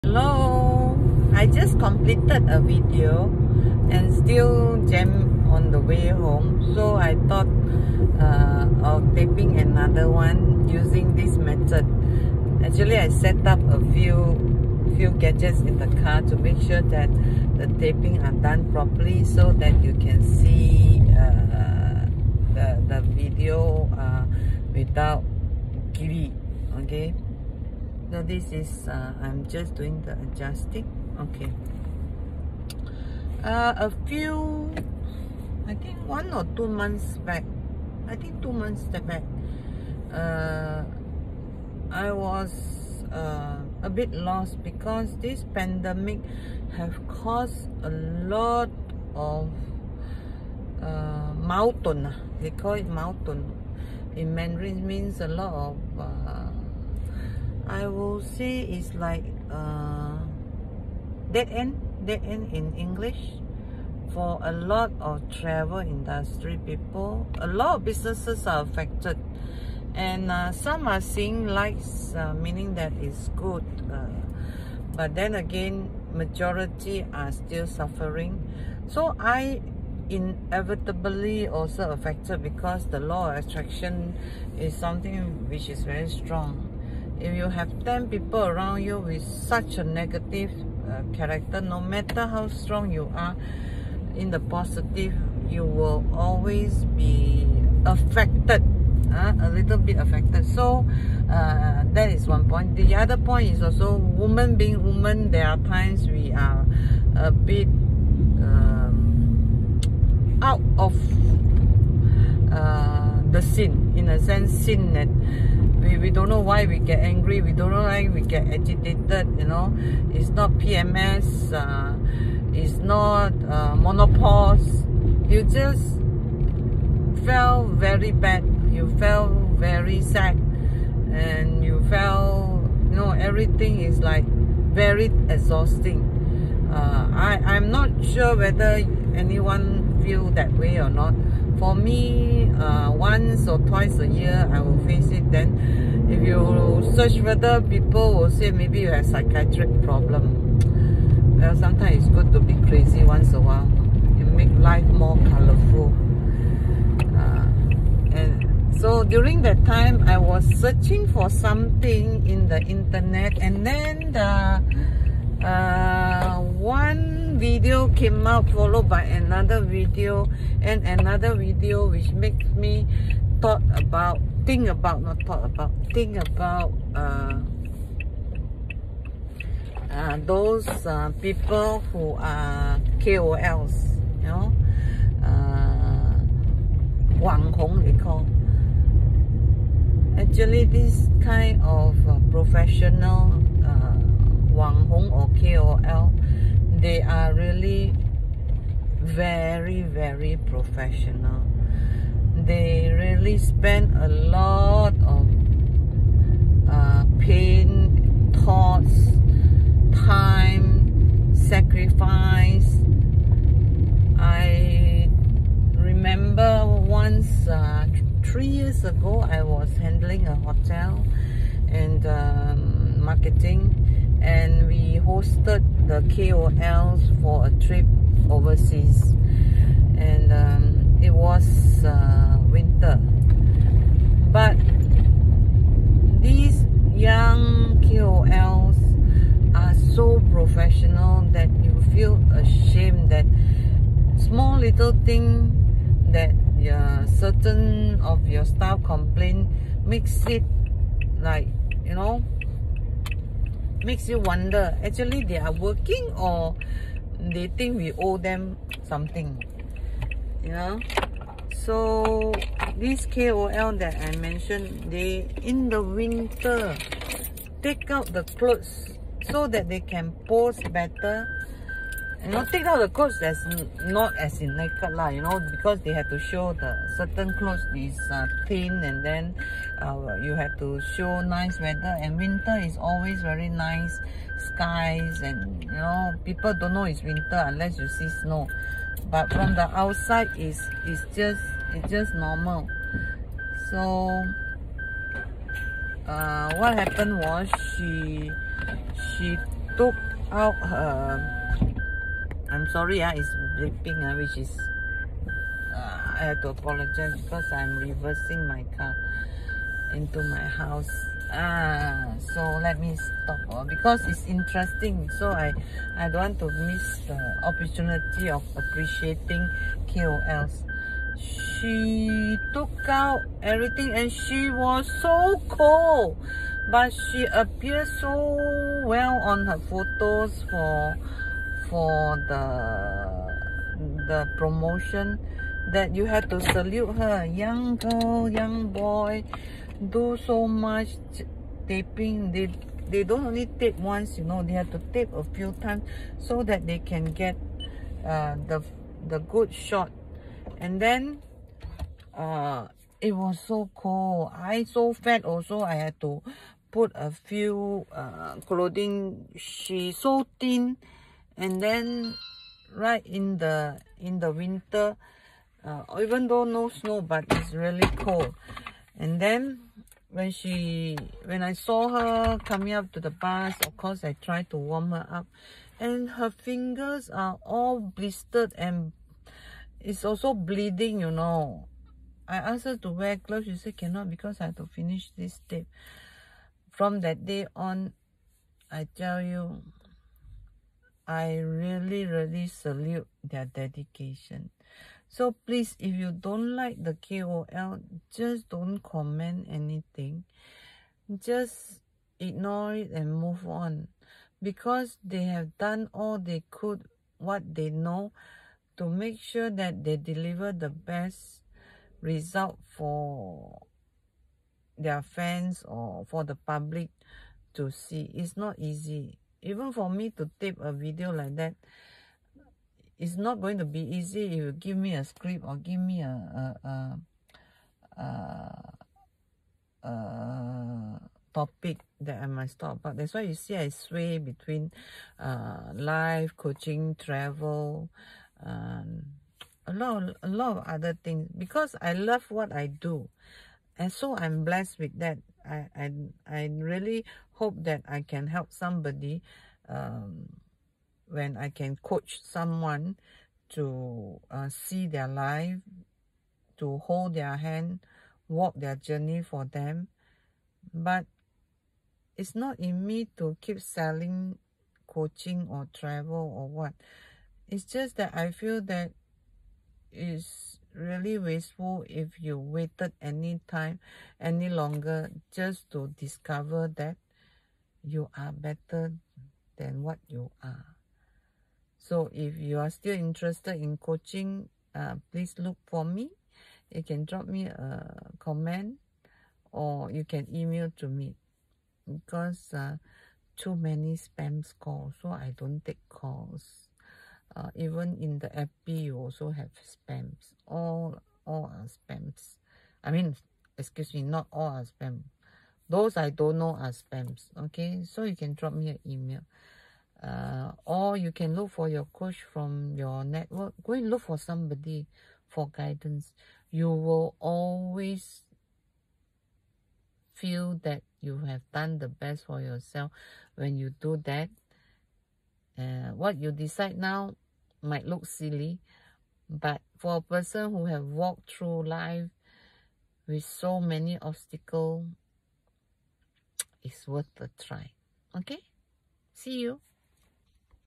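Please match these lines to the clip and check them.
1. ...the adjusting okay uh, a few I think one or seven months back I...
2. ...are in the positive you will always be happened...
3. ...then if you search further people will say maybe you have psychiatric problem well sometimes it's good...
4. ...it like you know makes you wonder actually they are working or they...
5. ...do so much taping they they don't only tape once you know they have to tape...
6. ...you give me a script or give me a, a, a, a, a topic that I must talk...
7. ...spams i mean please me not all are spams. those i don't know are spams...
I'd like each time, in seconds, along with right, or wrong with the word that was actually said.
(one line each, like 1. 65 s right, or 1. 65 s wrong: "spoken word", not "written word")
1. 30 s wrong: "two", not "seven"
2. 93 s wrong: "affected", not "happened"
3. 145 s right
4. 250 s right
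5. 339 s right
6. 424 s right
7. 501 s wrong: "excuse", not "please".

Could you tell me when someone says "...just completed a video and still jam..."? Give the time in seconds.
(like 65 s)
1 s.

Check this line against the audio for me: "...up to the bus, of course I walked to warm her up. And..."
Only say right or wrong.
wrong.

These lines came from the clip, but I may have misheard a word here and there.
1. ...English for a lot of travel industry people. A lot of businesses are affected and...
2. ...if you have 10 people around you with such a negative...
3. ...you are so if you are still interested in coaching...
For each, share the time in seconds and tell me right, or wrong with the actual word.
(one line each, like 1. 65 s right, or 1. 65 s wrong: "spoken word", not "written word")
1. 62 s right
2. 87 s right
3. 480 s right.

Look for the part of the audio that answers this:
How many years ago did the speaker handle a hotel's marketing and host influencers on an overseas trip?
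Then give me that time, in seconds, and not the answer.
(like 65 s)
218 s.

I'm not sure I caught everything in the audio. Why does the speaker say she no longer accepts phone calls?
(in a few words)
too many spam calls.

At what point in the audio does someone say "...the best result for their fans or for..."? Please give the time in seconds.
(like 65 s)
410 s.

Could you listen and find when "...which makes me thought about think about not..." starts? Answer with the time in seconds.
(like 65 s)
171 s.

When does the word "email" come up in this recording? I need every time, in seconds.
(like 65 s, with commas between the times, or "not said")
490 s, 508 s.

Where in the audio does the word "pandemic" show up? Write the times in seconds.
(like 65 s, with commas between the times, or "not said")
45 s.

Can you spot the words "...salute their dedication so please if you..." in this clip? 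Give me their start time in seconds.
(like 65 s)
392 s.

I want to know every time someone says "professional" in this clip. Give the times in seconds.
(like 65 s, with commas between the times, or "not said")
192 s, 200 s, 240 s.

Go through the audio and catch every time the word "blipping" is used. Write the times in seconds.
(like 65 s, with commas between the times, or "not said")
303 s.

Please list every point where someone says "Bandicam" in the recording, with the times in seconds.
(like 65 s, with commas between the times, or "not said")
not said.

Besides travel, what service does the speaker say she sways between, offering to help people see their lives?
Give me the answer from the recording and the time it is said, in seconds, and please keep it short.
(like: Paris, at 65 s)
life coaching, at 435 s.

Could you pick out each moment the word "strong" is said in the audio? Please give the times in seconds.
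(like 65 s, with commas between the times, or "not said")
86 s, 92 s.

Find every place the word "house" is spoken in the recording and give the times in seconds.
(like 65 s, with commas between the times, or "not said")
310 s.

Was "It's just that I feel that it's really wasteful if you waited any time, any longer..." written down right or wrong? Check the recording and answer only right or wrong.
right.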